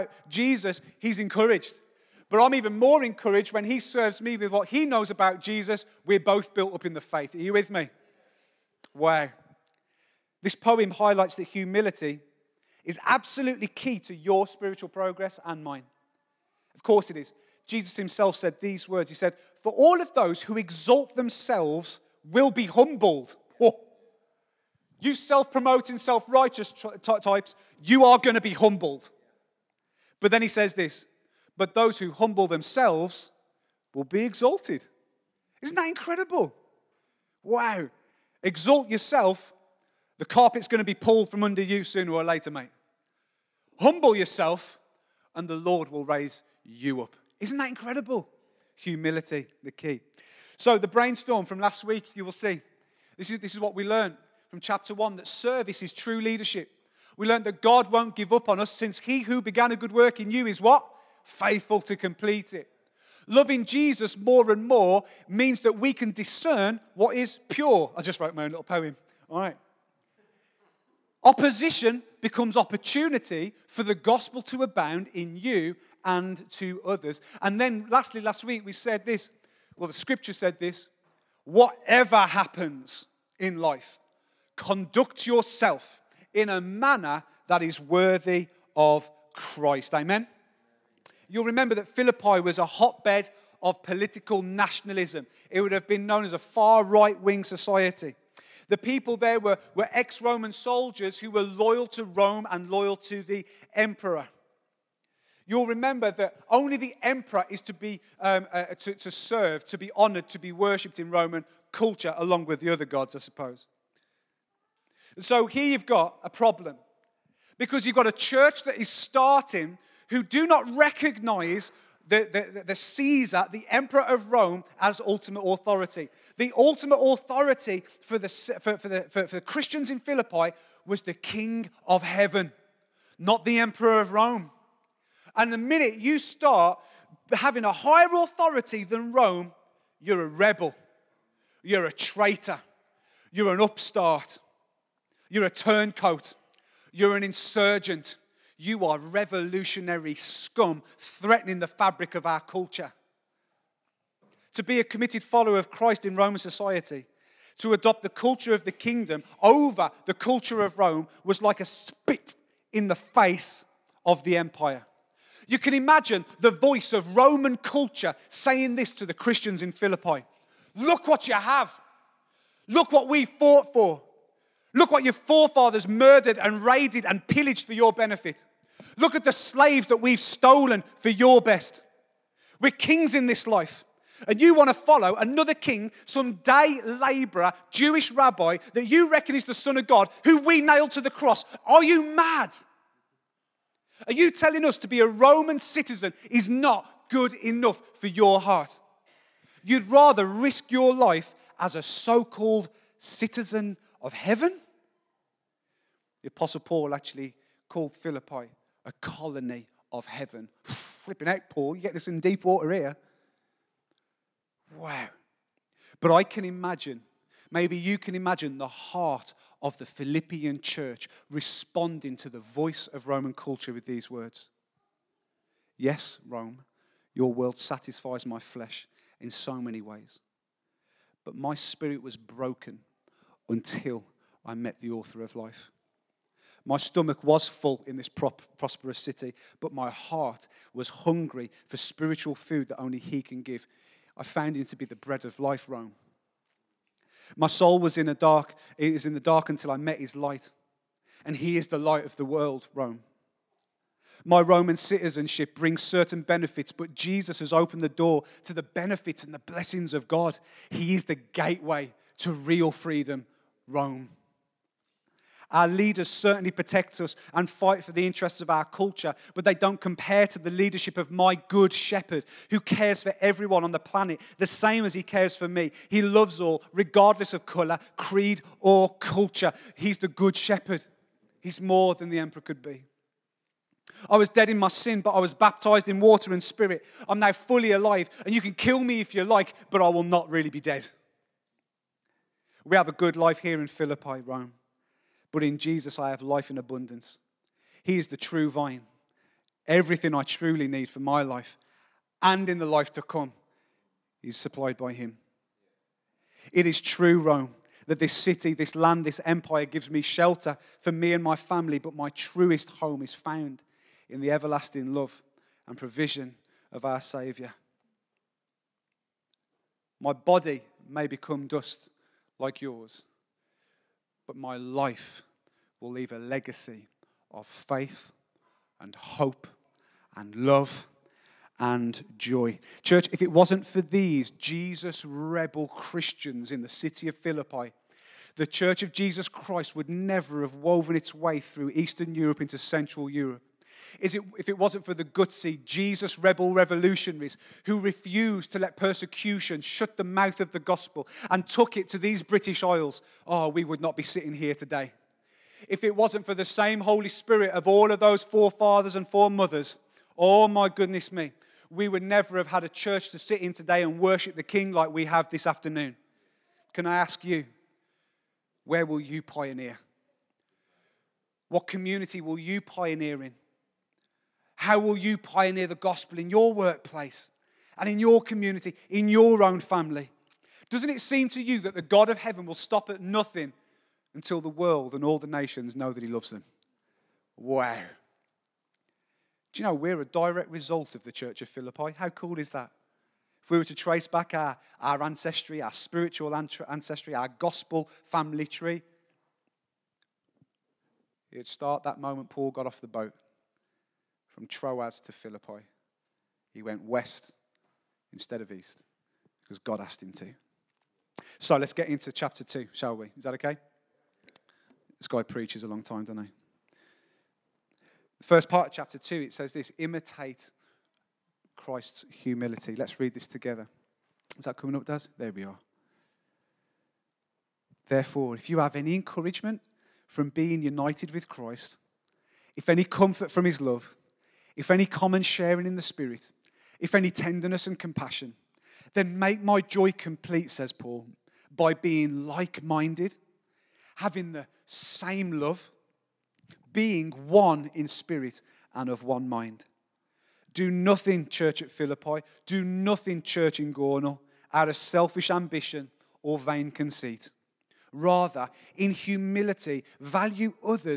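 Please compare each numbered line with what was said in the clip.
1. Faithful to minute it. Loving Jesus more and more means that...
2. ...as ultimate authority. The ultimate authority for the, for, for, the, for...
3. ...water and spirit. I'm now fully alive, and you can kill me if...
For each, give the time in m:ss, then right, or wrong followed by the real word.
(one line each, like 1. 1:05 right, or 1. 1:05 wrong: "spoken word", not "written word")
1. 1:01 wrong: "complete", not "minute"
2. 2:04 right
3. 4:46 right.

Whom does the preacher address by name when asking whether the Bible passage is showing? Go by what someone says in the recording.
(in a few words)
Daz.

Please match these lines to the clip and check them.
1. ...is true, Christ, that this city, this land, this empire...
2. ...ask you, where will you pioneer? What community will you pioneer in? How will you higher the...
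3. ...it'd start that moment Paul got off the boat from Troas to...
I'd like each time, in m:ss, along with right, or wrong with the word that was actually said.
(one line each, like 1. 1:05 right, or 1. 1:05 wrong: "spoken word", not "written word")
1. 5:06 wrong: "Rome", not "Christ"
2. 6:06 wrong: "pioneer", not "higher"
3. 6:41 right.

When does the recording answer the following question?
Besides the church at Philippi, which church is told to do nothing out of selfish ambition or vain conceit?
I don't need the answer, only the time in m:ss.
7:33.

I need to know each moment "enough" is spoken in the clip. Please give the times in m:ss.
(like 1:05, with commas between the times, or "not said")
3:17.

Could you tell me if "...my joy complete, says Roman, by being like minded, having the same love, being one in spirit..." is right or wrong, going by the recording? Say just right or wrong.
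wrong.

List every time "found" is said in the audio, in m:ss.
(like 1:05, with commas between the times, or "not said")
4:04, 5:13.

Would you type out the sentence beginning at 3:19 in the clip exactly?
You'd rather risk your life as a so called citizen of heaven?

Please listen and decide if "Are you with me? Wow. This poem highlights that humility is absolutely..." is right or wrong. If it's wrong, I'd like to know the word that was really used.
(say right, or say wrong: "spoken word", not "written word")
right.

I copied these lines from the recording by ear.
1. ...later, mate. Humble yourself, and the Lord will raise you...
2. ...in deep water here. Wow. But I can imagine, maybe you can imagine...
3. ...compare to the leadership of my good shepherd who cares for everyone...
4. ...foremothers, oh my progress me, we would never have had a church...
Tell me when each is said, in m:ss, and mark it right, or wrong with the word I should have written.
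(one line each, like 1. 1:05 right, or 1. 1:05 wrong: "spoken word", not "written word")
1. 0:42 right
2. 3:32 right
3. 4:29 right
4. 5:59 wrong: "goodness", not "progress".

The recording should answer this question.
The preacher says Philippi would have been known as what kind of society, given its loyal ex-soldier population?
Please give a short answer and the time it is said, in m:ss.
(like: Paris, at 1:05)
far right wing society, at 1:36.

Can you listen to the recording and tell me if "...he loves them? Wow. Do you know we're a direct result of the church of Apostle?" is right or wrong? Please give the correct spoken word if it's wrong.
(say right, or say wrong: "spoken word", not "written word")
wrong: "Philippi", not "Apostle".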